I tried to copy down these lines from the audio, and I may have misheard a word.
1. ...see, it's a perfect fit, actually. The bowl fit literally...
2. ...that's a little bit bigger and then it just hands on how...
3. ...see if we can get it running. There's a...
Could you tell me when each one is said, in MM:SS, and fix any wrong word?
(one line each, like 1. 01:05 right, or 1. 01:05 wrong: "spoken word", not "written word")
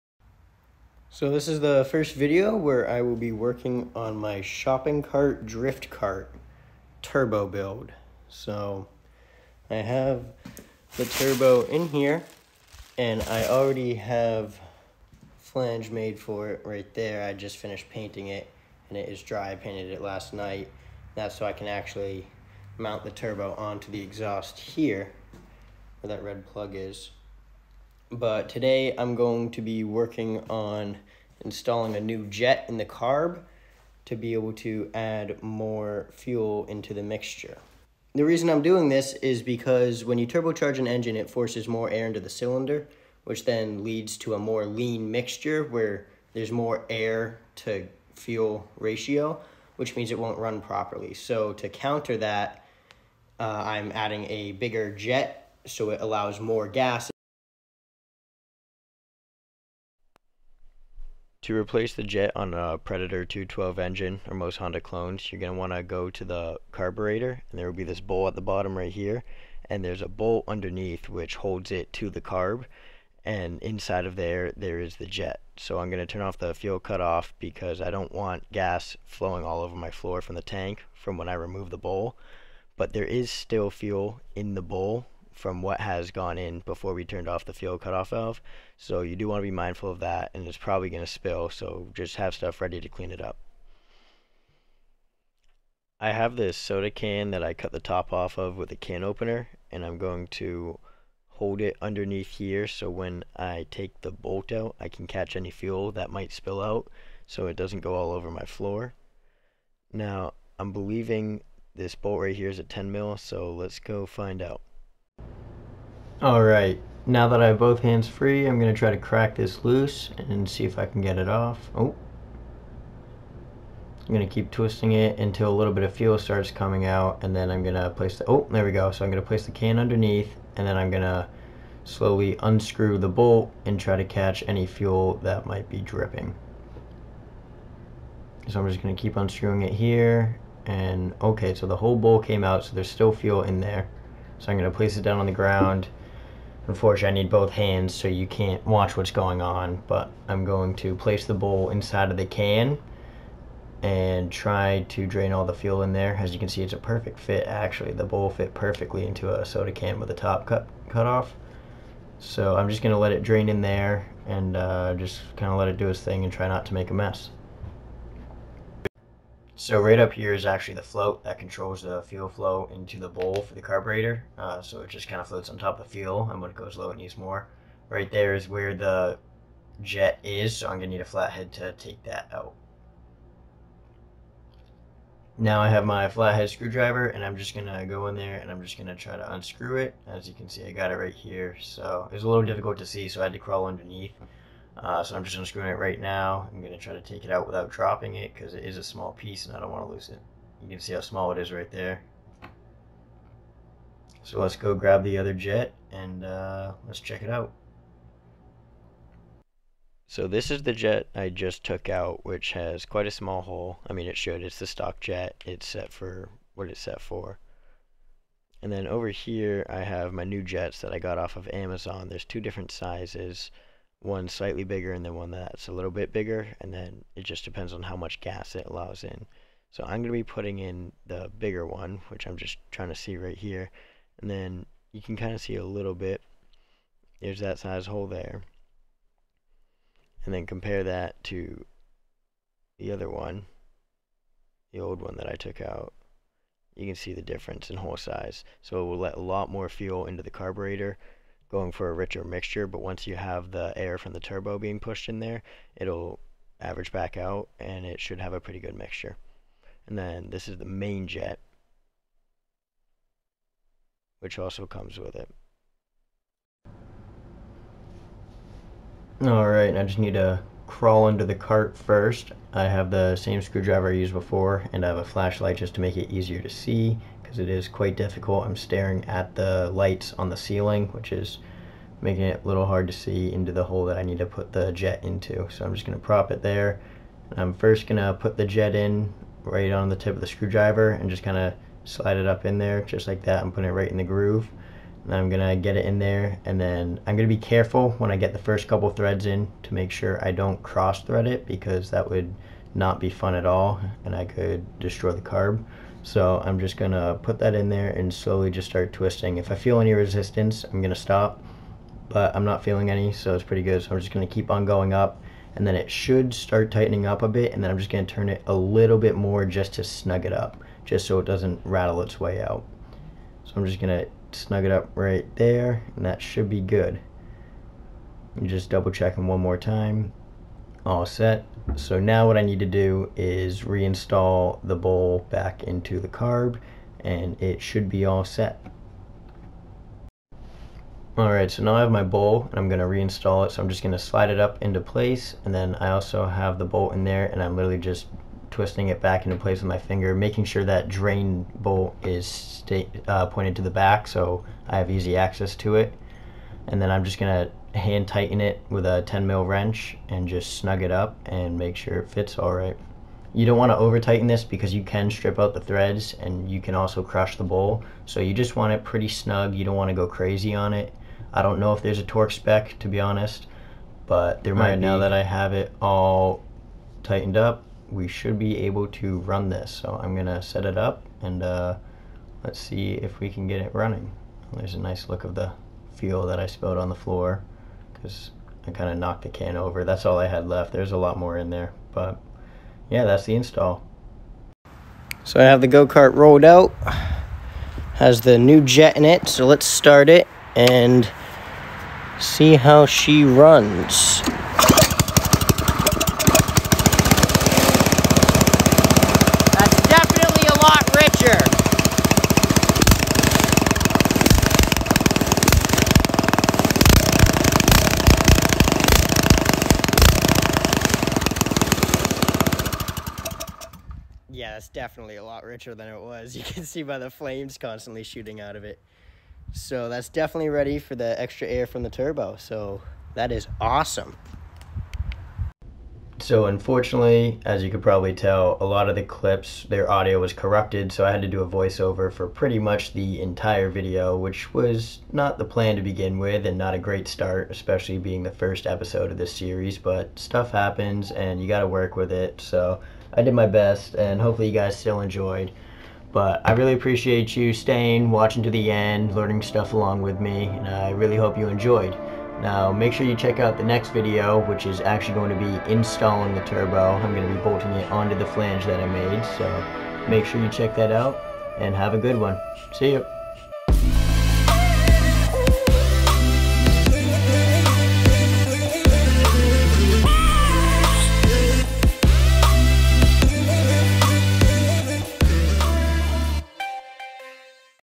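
1. 02:36 wrong: "perfectly", not "literally"
2. 03:45 wrong: "depends", not "hands"
3. 06:22 right.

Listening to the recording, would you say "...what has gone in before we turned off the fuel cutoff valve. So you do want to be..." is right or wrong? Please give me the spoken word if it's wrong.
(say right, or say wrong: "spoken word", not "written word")
right.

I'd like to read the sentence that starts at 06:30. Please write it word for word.
There's a lot more in there, but yeah, that's the install.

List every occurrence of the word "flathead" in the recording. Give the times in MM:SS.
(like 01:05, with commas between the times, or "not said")
03:01, 03:06.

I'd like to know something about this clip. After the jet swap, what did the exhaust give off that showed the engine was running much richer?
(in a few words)
flames.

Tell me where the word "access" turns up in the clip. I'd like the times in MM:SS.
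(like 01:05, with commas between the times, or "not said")
05:55.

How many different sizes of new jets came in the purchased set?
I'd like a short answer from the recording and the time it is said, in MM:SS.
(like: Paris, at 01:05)
2, at 03:42.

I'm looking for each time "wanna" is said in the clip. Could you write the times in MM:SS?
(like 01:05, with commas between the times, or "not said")
06:03, 06:09.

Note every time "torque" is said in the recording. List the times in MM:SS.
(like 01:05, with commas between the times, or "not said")
06:12.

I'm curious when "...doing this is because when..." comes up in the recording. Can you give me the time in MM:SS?
00:38.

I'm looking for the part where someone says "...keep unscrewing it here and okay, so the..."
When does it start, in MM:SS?
02:18.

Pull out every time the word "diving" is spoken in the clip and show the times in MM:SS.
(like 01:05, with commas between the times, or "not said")
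not said.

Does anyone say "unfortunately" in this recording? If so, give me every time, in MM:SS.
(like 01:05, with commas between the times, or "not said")
02:26, 07:16.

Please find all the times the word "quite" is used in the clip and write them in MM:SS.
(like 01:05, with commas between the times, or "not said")
03:32, 04:37.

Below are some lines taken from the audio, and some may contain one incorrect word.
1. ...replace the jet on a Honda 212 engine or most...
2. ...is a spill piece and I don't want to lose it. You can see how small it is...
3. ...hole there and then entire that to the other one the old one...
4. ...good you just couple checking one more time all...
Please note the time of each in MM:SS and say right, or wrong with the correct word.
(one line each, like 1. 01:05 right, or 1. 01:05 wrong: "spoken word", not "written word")
1. 01:01 wrong: "Predator", not "Honda"
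2. 03:18 wrong: "small", not "spill"
3. 03:57 wrong: "compare", not "entire"
4. 05:26 wrong: "double", not "couple".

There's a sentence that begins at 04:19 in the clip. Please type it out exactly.
And then this is the main jet, which also comes with it.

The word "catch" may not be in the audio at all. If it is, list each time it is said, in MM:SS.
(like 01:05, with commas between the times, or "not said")
01:45, 02:14.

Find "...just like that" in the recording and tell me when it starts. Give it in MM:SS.
04:52.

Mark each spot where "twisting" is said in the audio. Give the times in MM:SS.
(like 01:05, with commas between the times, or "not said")
02:04, 05:08, 05:48.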